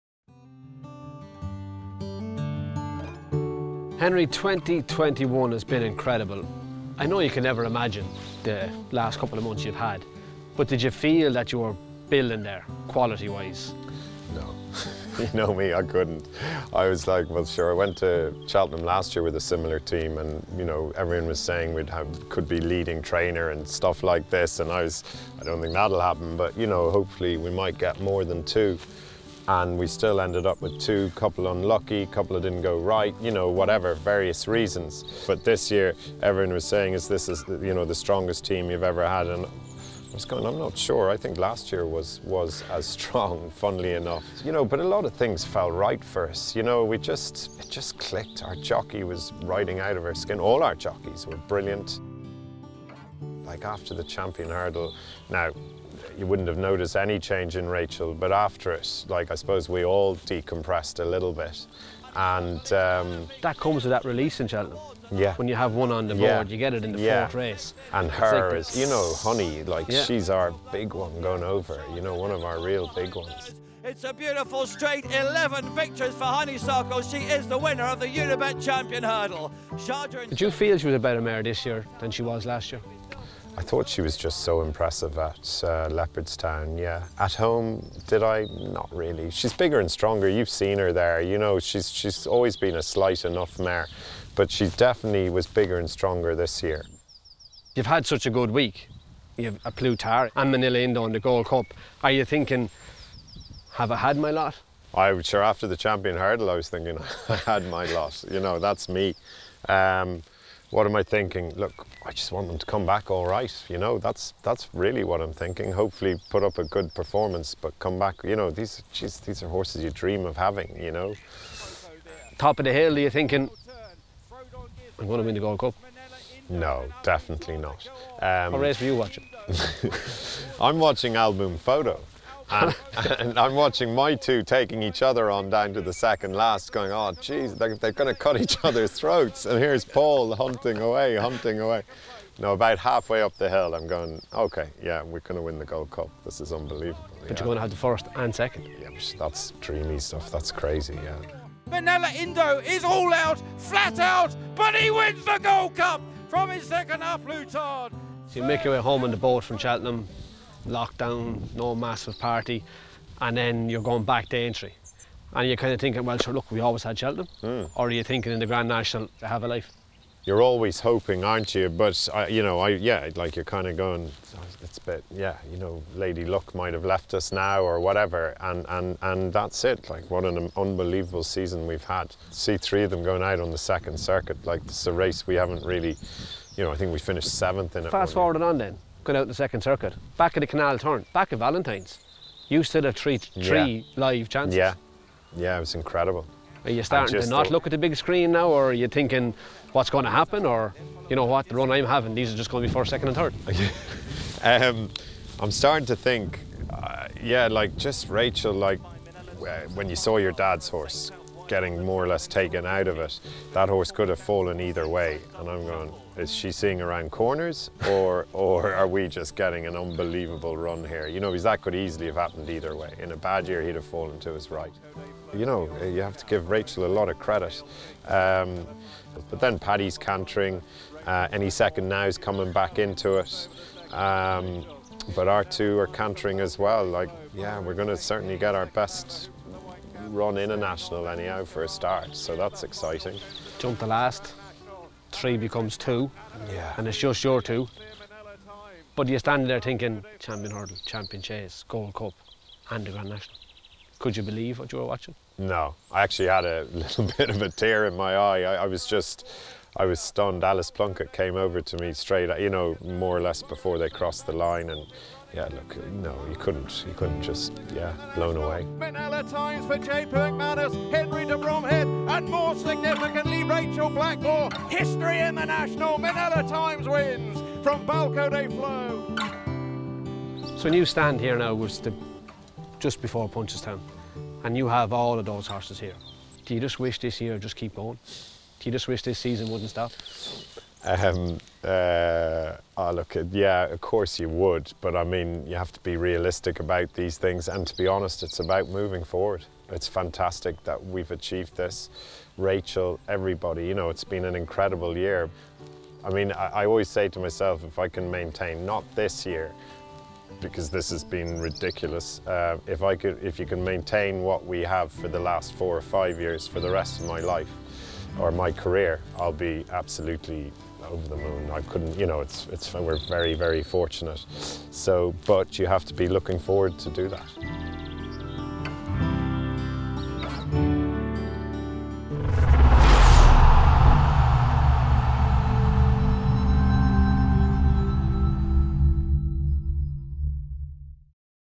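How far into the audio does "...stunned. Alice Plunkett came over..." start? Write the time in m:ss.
4:19.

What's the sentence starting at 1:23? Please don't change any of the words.
I thought she was just so impressive at uh, Leopardstown, yeah.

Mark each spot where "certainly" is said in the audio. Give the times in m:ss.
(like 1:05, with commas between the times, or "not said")
3:57.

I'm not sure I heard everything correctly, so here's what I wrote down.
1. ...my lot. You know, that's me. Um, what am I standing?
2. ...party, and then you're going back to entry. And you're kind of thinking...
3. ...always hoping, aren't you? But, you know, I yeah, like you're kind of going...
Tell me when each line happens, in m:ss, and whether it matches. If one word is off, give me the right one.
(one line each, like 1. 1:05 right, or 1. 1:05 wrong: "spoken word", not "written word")
1. 1:47 wrong: "thinking", not "standing"
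2. 2:42 right
3. 2:50 right.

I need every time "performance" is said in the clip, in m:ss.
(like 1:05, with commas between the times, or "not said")
1:56.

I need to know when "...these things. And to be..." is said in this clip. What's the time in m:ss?
4:56.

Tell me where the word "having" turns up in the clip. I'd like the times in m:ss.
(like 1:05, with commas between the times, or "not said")
2:00, 3:21.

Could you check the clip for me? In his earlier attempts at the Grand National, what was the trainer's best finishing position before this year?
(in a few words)
Seventh.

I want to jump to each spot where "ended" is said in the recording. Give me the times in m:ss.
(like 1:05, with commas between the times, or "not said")
0:30.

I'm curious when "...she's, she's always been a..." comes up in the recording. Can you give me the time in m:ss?
1:31.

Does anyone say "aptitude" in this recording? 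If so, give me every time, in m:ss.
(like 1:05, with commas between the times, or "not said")
not said.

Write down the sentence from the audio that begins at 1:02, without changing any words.
And um, that comes with that release in Cheltenham.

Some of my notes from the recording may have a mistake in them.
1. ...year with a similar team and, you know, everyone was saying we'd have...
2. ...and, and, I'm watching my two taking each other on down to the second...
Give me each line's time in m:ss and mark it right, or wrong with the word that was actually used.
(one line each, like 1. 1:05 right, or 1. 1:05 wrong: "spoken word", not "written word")
1. 0:19 right
2. 2:12 right.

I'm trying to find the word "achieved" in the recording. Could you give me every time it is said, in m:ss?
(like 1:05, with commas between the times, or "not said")
5:01.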